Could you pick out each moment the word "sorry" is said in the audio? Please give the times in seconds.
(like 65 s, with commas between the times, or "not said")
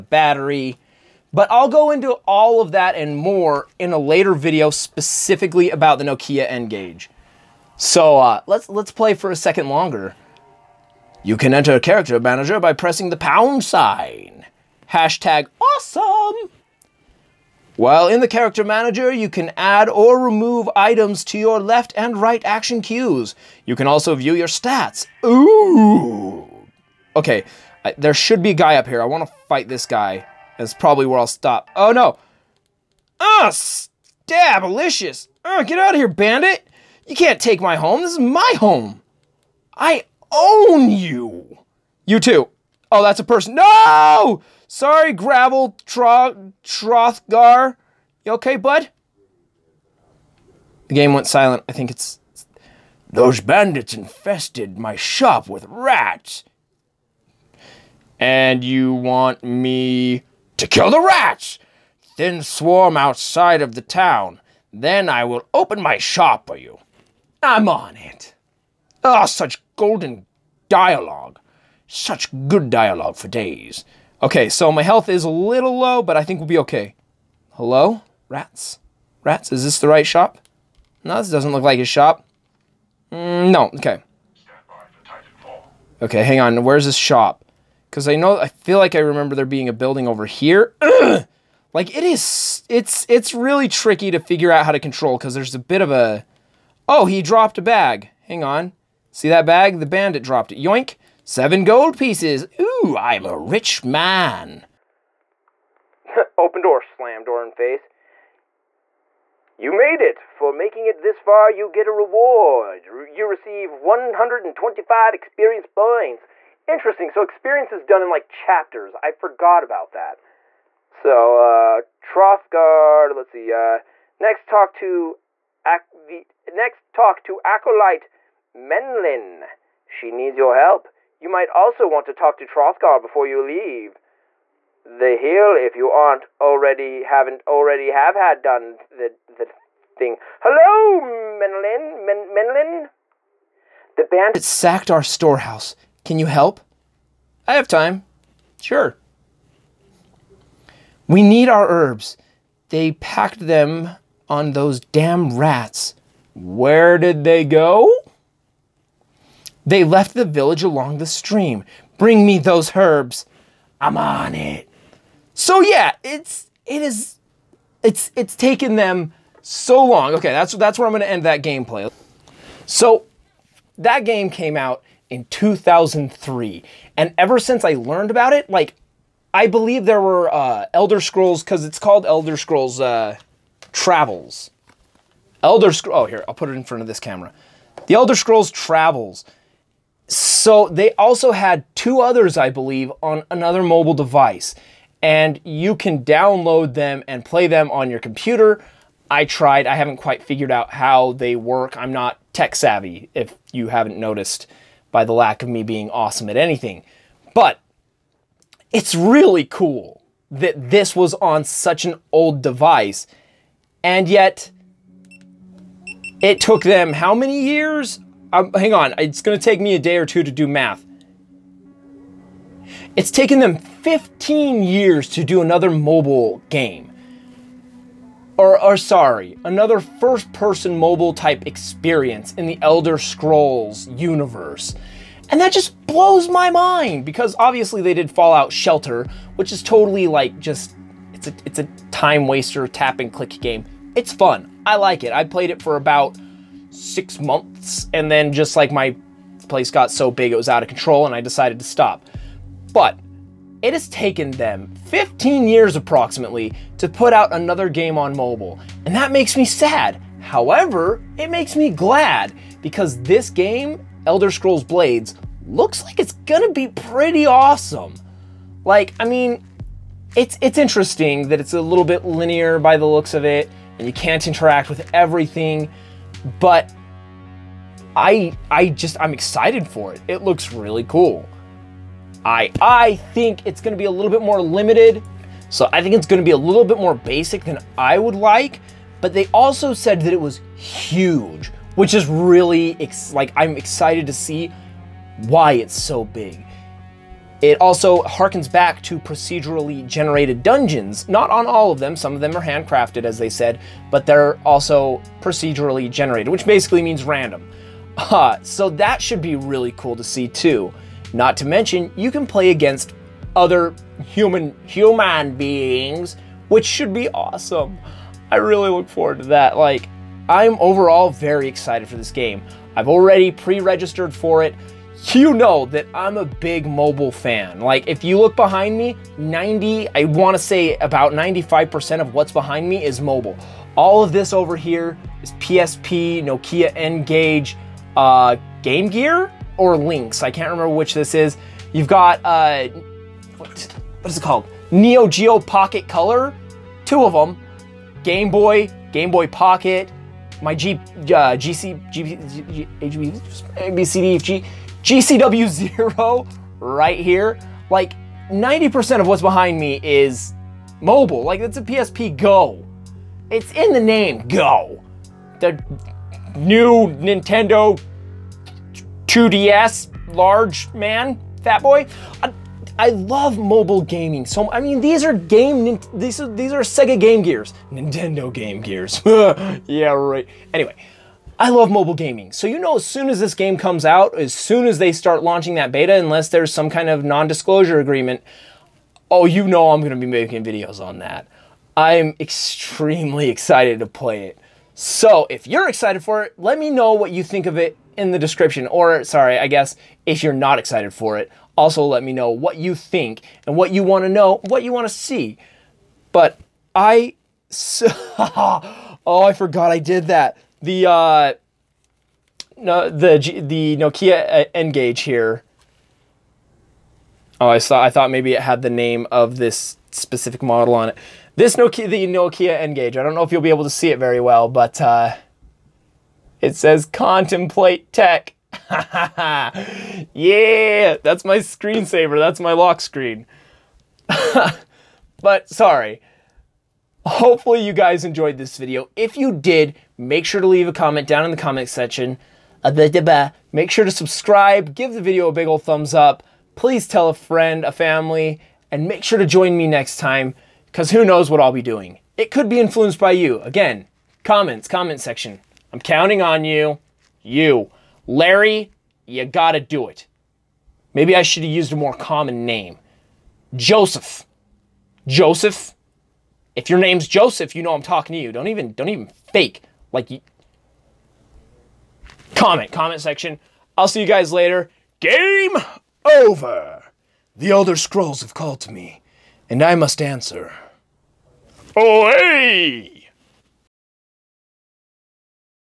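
44 s, 228 s, 399 s, 435 s.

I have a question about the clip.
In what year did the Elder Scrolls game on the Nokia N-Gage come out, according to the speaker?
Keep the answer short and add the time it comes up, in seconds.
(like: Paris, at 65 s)
2003, at 175 s.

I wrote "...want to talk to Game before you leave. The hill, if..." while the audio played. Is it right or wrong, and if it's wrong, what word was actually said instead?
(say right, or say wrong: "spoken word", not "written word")
wrong: "Trothgar", not "Game".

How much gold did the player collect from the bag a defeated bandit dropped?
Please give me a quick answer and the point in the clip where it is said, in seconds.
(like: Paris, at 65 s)
7 gold pieces, at 101 s.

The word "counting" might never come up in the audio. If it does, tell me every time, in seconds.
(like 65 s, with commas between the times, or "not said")
455 s.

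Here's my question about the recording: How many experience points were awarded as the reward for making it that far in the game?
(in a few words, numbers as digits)
125.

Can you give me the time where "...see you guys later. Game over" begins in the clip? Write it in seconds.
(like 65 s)
473 s.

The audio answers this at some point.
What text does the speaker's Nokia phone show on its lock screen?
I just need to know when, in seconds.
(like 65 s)
426 s.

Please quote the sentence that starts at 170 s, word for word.
Okay, that's that's where I'm gonna end that gameplay.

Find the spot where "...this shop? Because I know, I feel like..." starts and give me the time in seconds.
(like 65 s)
86 s.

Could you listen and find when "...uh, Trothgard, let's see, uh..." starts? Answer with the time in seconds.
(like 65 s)
121 s.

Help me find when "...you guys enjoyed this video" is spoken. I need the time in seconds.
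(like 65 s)
437 s.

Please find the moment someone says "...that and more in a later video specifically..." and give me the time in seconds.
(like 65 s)
2 s.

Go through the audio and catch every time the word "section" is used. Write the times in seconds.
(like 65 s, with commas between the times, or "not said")
441 s, 454 s, 472 s.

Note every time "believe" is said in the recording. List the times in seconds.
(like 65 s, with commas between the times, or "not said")
179 s, 192 s.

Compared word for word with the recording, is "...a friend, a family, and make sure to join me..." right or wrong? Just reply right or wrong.
right.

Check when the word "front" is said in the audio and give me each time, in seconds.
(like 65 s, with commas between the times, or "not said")
186 s.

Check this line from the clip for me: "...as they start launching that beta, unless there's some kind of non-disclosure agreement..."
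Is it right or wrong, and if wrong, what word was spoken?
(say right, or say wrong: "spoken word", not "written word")
right.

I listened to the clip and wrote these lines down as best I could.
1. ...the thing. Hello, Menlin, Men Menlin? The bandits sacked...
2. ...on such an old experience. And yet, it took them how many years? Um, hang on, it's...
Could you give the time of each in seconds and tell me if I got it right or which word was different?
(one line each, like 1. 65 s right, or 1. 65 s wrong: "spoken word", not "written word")
1. 139 s right
2. 211 s wrong: "device", not "experience".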